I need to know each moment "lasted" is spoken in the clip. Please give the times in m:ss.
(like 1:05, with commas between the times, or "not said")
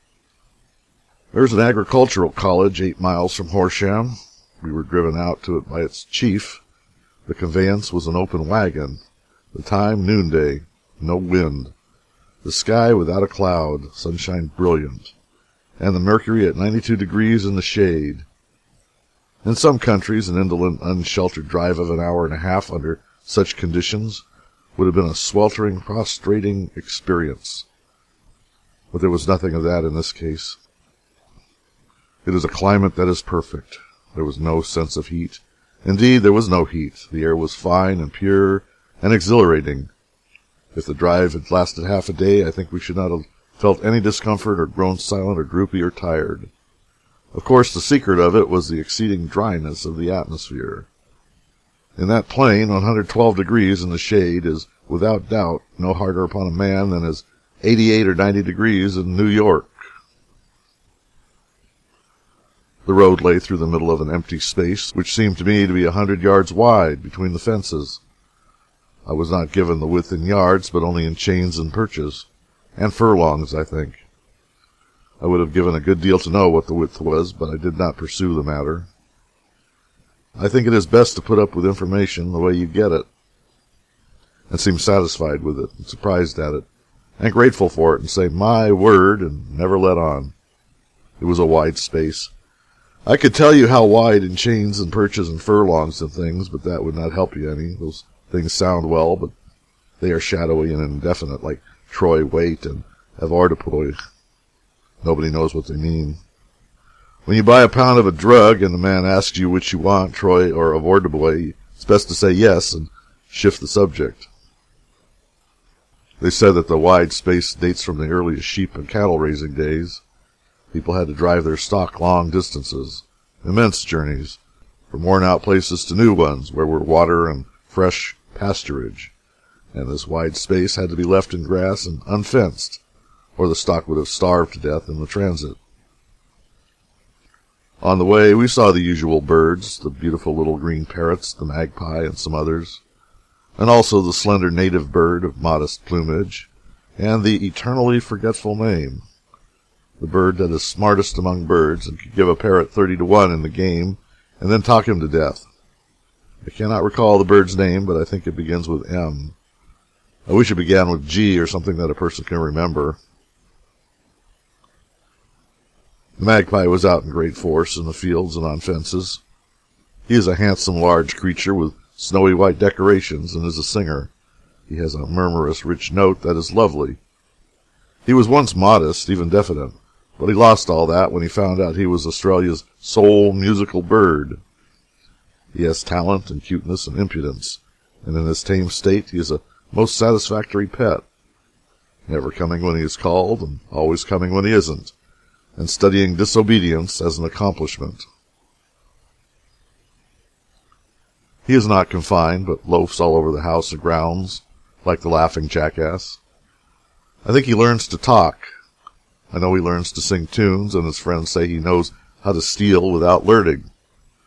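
0:41.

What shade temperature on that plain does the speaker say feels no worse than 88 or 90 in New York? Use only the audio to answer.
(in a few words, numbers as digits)
112 degrees.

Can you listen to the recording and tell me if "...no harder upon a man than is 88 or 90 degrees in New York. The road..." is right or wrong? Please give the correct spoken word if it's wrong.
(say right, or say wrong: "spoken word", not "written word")
right.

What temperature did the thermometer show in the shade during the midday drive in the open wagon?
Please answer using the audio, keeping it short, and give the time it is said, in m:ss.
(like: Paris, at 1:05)
92 degrees, at 0:16.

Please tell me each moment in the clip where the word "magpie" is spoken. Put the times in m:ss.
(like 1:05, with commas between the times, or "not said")
2:21, 2:46.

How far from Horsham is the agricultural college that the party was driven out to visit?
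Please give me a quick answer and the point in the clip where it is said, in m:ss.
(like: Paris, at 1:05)
8 miles, at 0:02.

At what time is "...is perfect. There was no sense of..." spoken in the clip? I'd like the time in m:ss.
0:33.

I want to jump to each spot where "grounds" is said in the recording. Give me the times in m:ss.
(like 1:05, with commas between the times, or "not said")
3:23.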